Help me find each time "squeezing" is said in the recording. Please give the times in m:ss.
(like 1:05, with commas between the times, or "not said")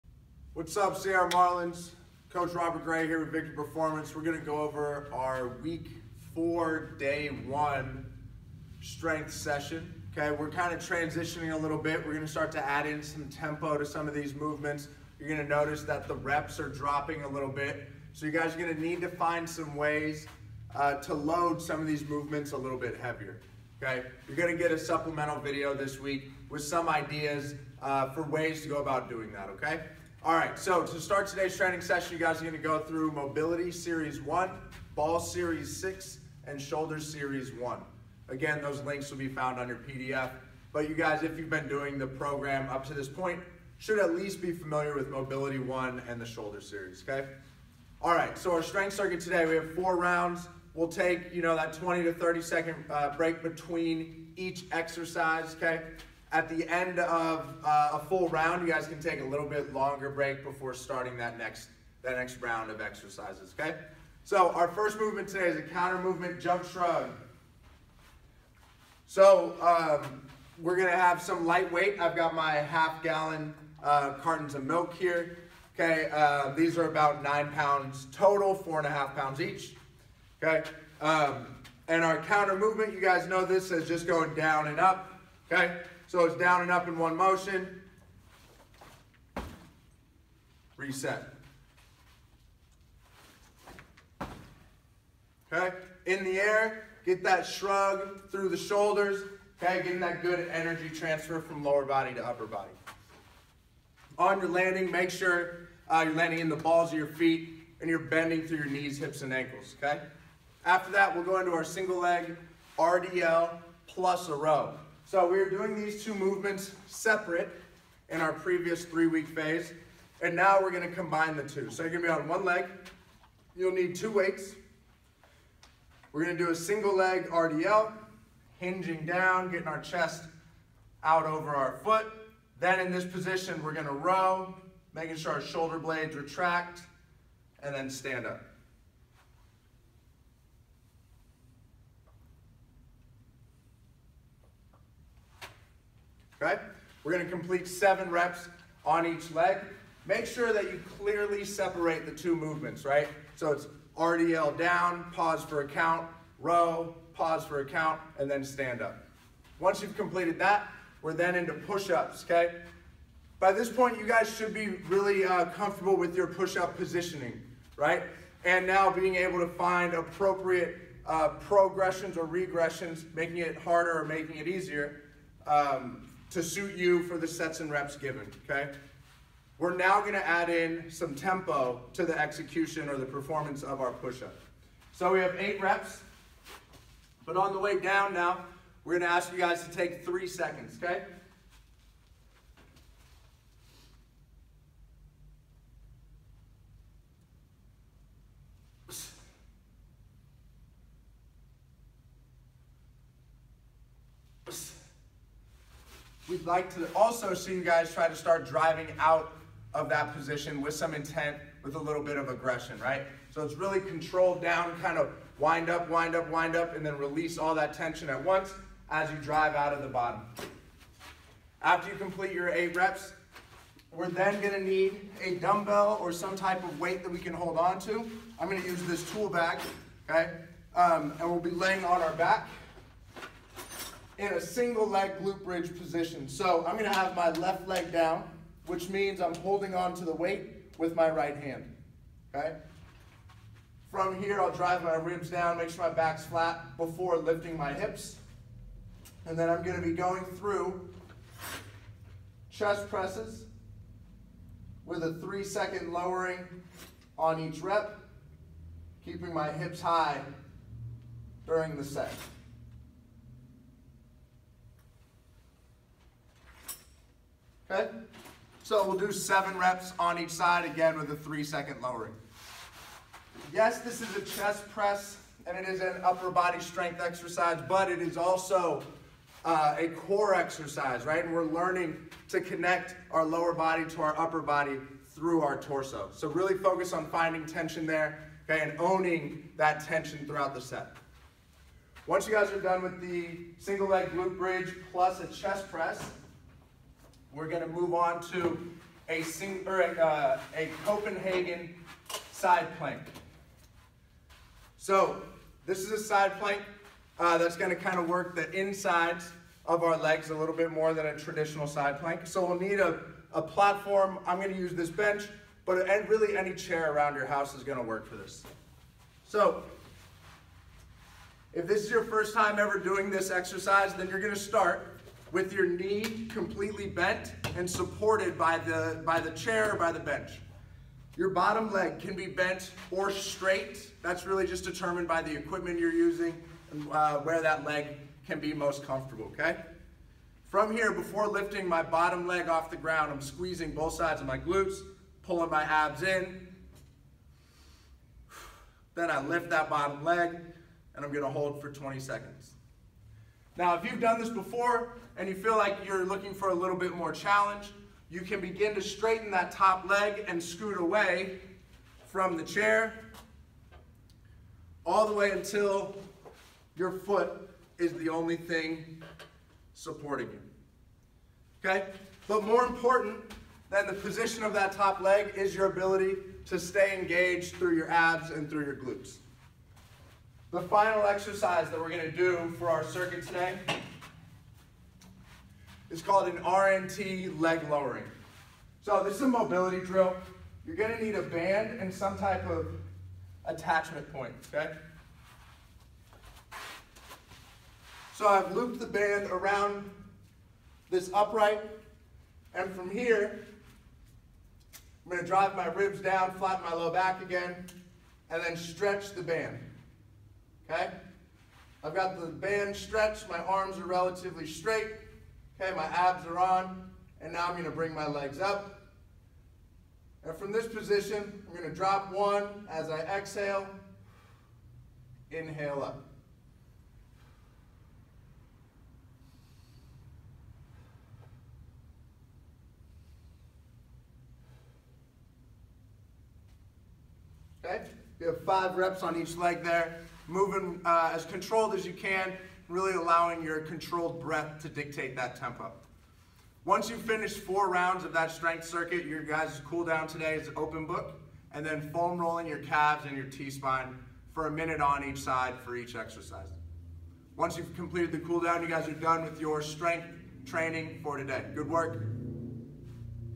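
5:43.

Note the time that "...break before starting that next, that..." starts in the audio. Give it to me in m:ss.
1:00.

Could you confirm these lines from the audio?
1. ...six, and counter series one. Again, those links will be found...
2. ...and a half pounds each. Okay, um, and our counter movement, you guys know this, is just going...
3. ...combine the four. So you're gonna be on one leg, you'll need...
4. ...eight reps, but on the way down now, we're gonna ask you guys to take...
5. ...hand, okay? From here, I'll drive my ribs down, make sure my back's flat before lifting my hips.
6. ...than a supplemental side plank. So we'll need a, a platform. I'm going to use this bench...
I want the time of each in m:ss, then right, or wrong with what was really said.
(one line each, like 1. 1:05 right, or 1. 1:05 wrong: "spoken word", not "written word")
1. 0:35 wrong: "shoulder", not "counter"
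2. 1:18 right
3. 2:00 wrong: "two", not "four"
4. 3:05 right
5. 4:01 right
6. 5:10 wrong: "traditional", not "supplemental".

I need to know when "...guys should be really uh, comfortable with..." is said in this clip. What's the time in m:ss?
2:44.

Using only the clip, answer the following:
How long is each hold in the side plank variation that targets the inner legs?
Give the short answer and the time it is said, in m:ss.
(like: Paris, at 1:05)
20 seconds, at 5:51.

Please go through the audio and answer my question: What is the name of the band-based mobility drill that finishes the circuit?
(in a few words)
RNT leg lowering.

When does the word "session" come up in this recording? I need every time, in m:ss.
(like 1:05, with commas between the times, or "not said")
0:09, 0:31.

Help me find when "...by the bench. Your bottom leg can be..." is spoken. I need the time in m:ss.
5:29.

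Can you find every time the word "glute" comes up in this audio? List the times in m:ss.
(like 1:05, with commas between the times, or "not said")
3:55, 4:54, 5:44, 6:18.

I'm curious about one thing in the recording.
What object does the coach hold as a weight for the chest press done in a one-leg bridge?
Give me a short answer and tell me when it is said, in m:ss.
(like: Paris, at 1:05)
Tool bag, at 3:49.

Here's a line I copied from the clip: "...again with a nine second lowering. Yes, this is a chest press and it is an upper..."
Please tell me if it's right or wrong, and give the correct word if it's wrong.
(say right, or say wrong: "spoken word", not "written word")
wrong: "three", not "nine".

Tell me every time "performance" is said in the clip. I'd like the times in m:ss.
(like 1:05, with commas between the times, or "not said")
0:03, 3:03.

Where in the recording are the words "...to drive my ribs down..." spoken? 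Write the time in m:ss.
6:45.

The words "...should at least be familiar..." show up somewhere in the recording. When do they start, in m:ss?
0:43.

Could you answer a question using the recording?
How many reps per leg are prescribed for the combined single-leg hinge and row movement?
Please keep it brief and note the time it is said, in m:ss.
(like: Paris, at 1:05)
7, at 2:27.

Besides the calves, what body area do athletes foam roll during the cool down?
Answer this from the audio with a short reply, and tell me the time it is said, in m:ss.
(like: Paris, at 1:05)
T-spine, at 7:33.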